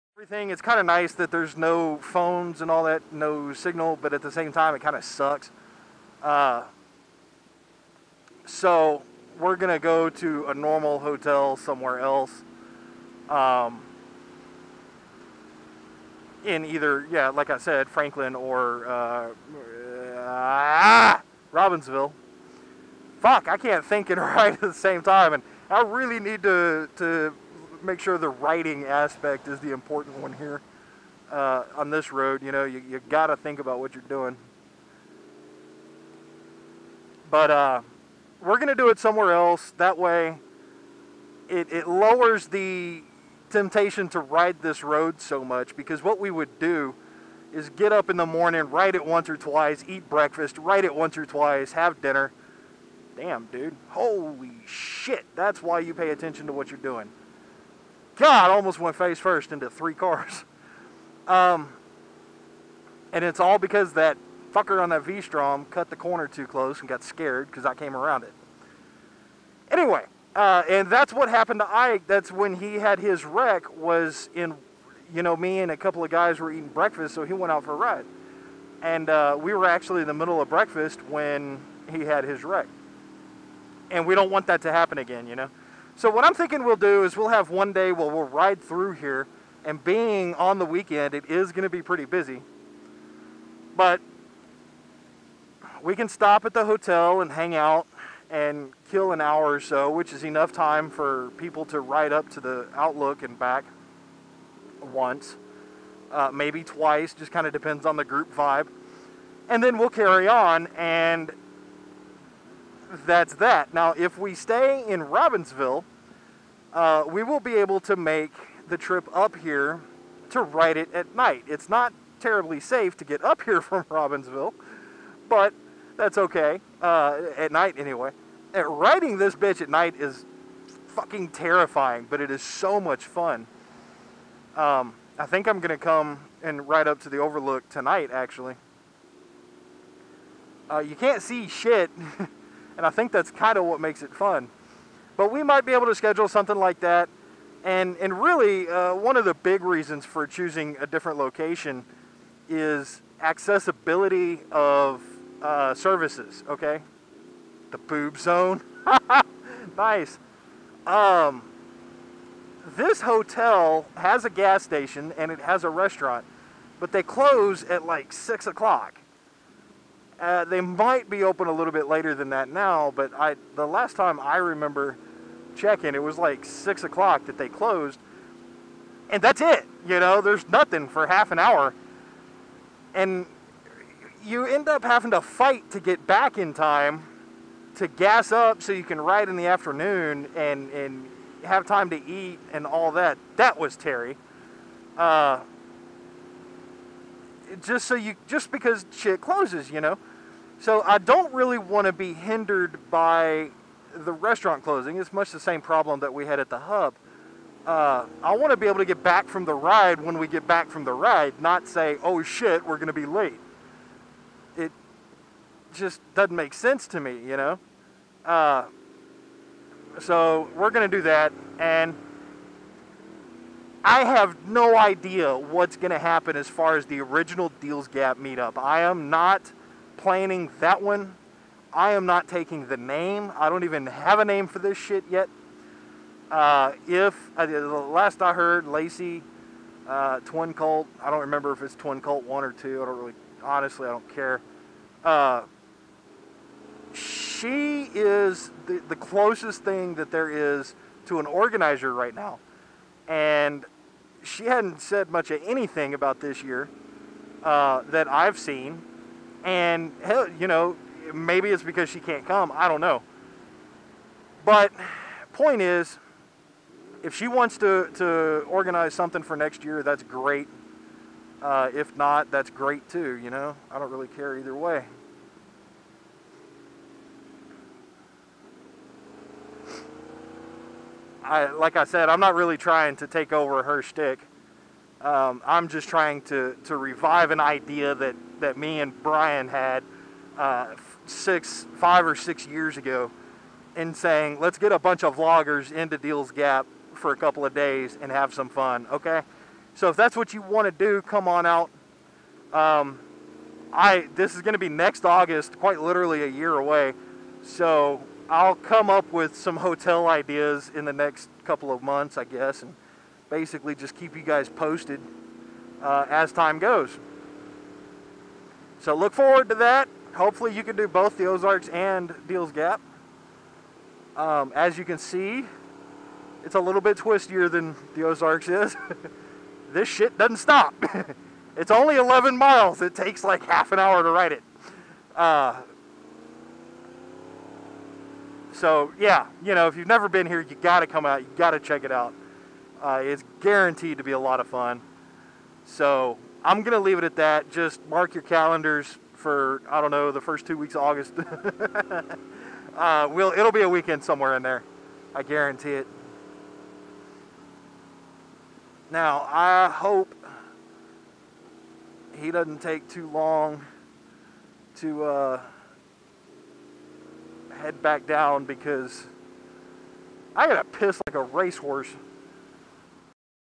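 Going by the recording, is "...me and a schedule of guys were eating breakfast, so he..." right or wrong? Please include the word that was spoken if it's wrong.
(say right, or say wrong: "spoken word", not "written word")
wrong: "couple", not "schedule".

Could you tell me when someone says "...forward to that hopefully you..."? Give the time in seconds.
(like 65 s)
319 s.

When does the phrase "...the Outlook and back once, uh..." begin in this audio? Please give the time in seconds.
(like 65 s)
102 s.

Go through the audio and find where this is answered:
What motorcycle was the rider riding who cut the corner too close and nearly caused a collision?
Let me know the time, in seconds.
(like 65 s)
65 s.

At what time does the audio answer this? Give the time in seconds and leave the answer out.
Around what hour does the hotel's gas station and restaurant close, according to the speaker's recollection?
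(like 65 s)
168 s.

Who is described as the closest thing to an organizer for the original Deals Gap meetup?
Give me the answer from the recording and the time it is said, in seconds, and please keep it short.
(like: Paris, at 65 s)
Lacey, at 238 s.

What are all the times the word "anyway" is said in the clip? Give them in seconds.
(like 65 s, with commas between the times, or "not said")
69 s, 127 s.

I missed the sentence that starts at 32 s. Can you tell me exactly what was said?
You know, you, you got to think about what you're doing.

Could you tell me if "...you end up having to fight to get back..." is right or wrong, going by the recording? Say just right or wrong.
right.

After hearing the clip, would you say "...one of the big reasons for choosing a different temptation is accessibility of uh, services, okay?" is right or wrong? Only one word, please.
wrong.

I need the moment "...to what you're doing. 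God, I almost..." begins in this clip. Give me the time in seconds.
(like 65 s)
56 s.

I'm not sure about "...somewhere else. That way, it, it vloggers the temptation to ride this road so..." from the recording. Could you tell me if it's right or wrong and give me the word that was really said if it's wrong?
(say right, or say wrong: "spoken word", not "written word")
wrong: "lowers", not "vloggers".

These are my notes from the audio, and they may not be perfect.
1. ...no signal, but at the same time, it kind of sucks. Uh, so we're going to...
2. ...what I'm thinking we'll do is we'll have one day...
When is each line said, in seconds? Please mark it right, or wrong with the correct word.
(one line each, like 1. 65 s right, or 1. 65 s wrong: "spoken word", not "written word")
1. 3 s right
2. 86 s right.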